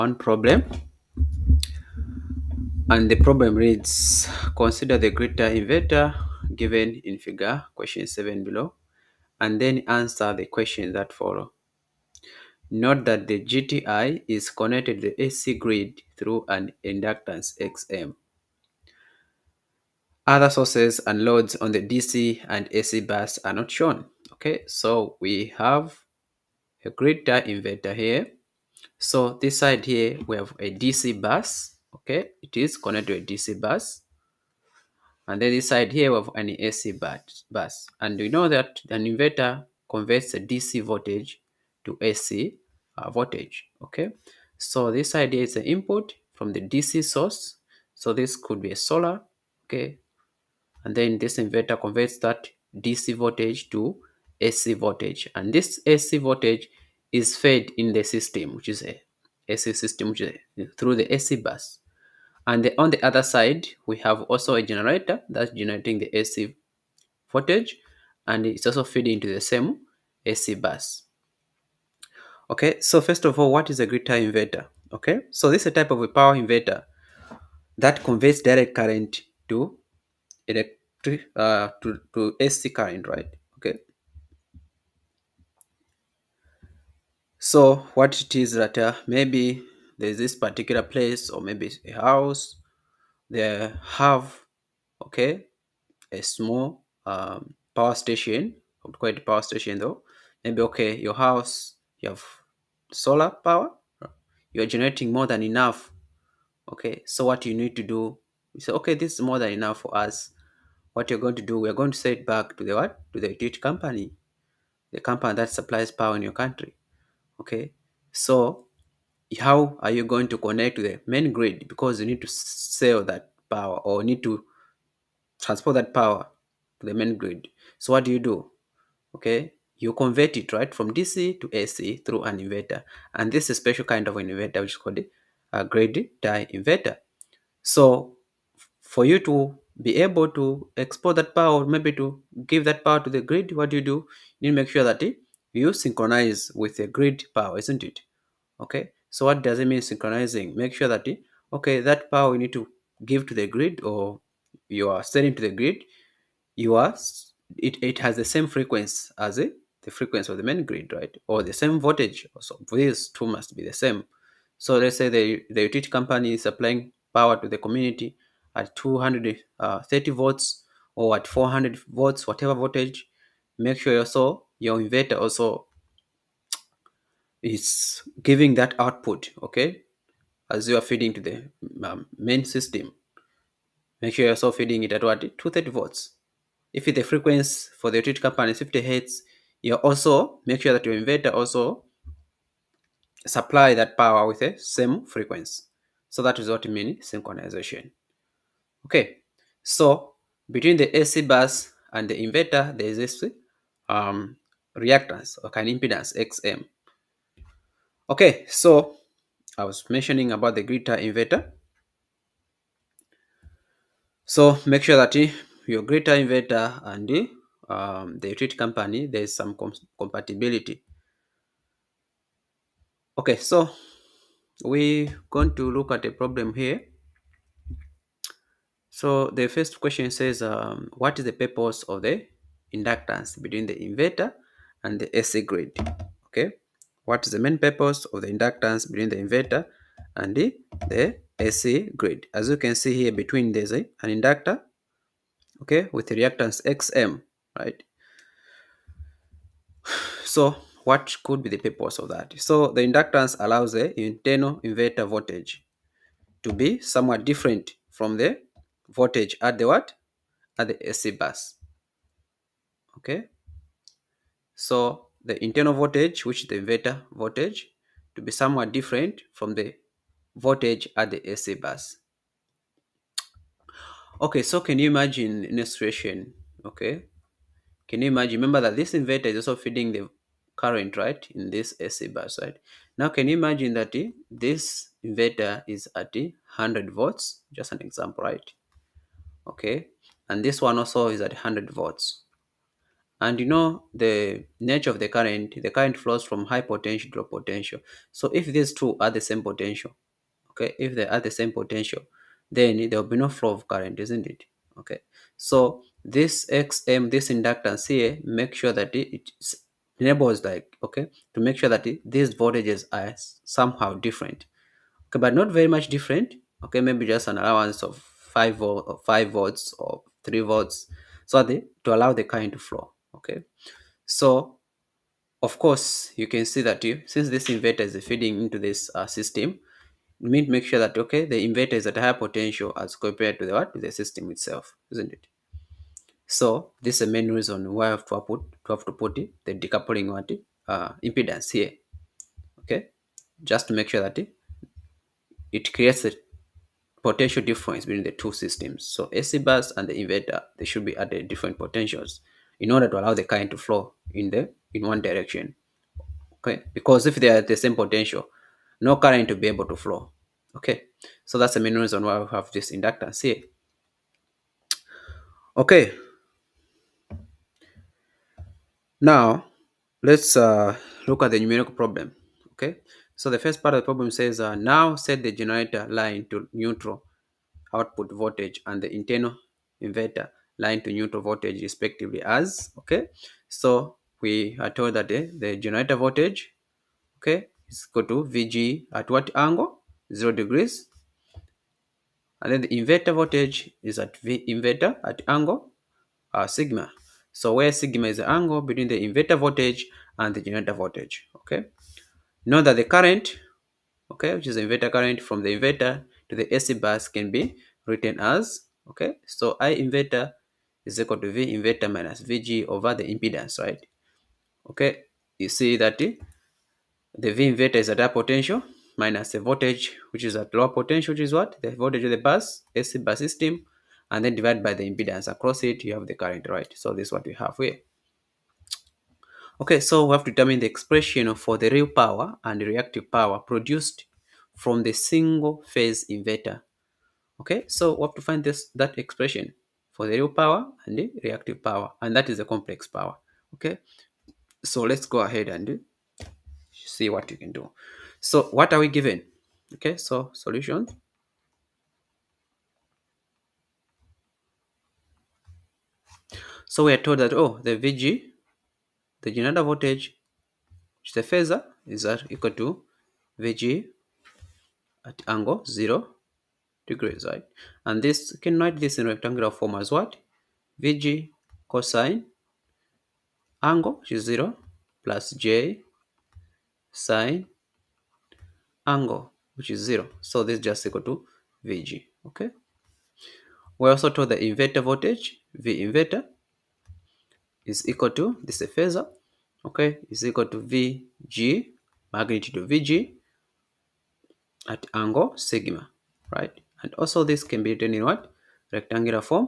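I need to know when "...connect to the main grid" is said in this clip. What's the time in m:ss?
2:00.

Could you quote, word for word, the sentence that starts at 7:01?
The voltage of the bus, AC bus system, and then divided by the impedance across it, you have the current, right?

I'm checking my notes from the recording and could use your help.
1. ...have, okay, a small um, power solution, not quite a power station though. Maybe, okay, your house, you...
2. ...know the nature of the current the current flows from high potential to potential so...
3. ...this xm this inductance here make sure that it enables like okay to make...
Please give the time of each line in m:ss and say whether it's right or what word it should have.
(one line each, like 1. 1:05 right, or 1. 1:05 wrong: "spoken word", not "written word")
1. 1:33 wrong: "station", not "solution"
2. 4:53 right
3. 5:06 right.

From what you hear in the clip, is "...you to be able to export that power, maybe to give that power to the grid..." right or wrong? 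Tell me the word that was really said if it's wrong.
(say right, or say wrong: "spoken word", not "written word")
right.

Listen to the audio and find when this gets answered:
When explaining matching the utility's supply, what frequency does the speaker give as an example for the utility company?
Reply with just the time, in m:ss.
3:08.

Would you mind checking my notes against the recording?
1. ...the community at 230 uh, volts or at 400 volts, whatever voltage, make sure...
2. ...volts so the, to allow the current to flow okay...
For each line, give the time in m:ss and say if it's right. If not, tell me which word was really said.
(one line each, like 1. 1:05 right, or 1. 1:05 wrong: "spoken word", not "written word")
1. 2:47 right
2. 5:20 right.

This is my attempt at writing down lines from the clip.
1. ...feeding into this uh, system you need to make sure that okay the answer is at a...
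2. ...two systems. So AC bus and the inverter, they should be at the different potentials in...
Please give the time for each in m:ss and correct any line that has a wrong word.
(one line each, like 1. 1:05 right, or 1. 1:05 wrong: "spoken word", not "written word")
1. 5:28 wrong: "inverter", not "answer"
2. 5:48 right.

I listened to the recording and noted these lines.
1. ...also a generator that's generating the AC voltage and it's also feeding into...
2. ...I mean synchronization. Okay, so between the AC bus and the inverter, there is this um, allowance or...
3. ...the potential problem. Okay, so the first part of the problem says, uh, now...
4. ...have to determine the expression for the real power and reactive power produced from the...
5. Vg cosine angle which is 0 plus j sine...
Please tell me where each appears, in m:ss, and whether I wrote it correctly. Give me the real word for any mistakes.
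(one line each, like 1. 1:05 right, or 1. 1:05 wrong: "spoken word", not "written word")
1. 1:04 right
2. 3:16 wrong: "reactance", not "allowance"
3. 6:11 wrong: "numerical", not "potential"
4. 7:10 right
5. 7:50 right.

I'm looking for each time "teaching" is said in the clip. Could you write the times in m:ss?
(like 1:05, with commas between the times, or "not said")
not said.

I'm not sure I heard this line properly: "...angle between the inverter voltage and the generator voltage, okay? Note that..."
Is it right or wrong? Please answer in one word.
right.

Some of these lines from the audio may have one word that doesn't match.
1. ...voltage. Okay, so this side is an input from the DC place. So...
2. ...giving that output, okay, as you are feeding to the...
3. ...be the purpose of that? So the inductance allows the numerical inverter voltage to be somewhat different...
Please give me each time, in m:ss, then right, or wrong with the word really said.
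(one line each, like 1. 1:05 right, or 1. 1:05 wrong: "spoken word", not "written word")
1. 0:43 wrong: "source", not "place"
2. 2:58 right
3. 4:11 wrong: "internal", not "numerical".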